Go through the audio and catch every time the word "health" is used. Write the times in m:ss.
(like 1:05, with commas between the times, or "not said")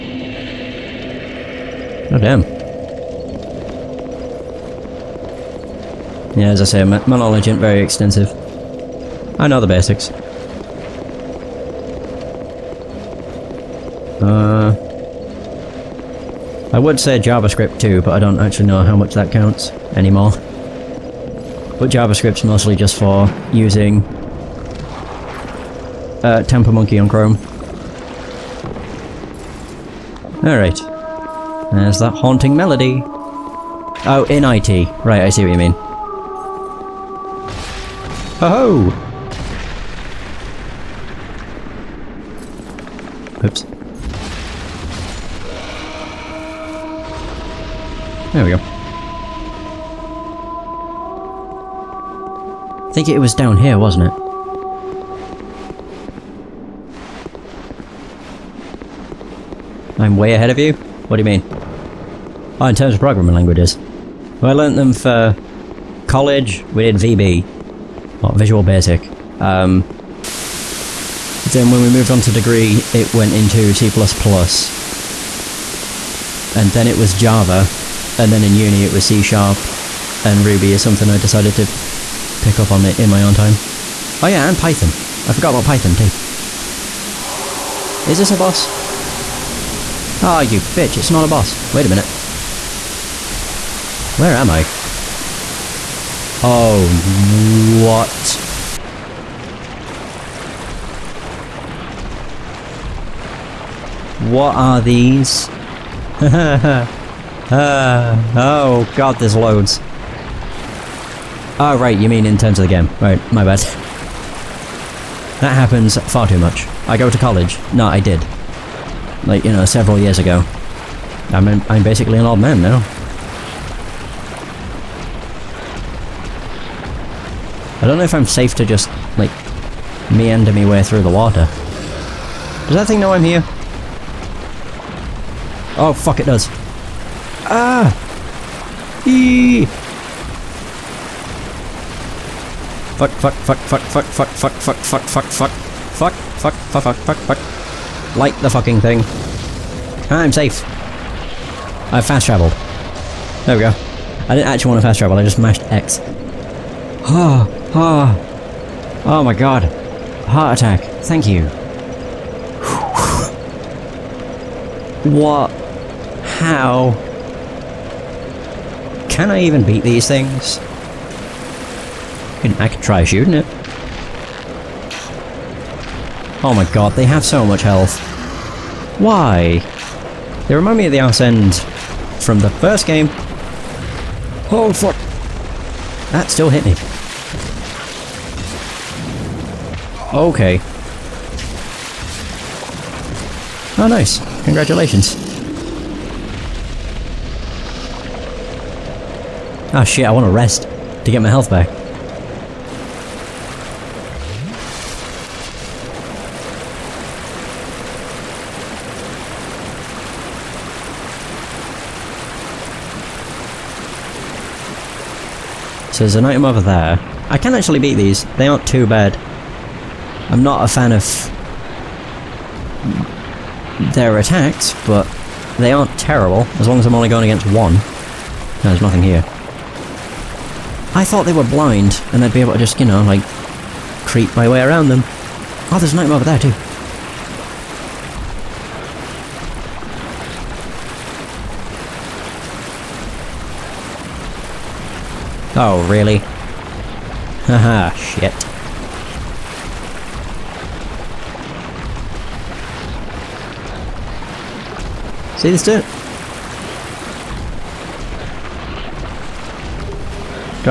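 2:57, 3:21.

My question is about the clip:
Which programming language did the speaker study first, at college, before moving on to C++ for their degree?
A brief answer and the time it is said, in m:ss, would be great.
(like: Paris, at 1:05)
Visual Basic, at 1:08.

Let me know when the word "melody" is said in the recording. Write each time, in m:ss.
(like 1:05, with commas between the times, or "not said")
0:32.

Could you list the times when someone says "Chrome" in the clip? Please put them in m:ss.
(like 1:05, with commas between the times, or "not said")
0:27.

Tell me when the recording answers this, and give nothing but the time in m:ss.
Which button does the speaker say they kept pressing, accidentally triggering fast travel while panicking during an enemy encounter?
2:35.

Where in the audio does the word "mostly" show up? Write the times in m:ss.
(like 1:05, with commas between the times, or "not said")
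0:22.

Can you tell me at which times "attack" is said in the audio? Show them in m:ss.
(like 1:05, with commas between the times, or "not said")
2:40, 3:44.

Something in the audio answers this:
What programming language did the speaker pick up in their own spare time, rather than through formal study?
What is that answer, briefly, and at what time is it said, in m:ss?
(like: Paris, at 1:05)
Ruby, at 1:20.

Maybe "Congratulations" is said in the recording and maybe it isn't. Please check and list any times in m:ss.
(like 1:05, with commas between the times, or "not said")
3:14.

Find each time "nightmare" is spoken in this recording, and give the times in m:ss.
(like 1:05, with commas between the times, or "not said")
3:55.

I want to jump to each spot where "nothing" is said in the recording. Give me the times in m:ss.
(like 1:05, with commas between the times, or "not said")
3:48.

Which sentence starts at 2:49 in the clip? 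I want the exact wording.
Can I even beat these things?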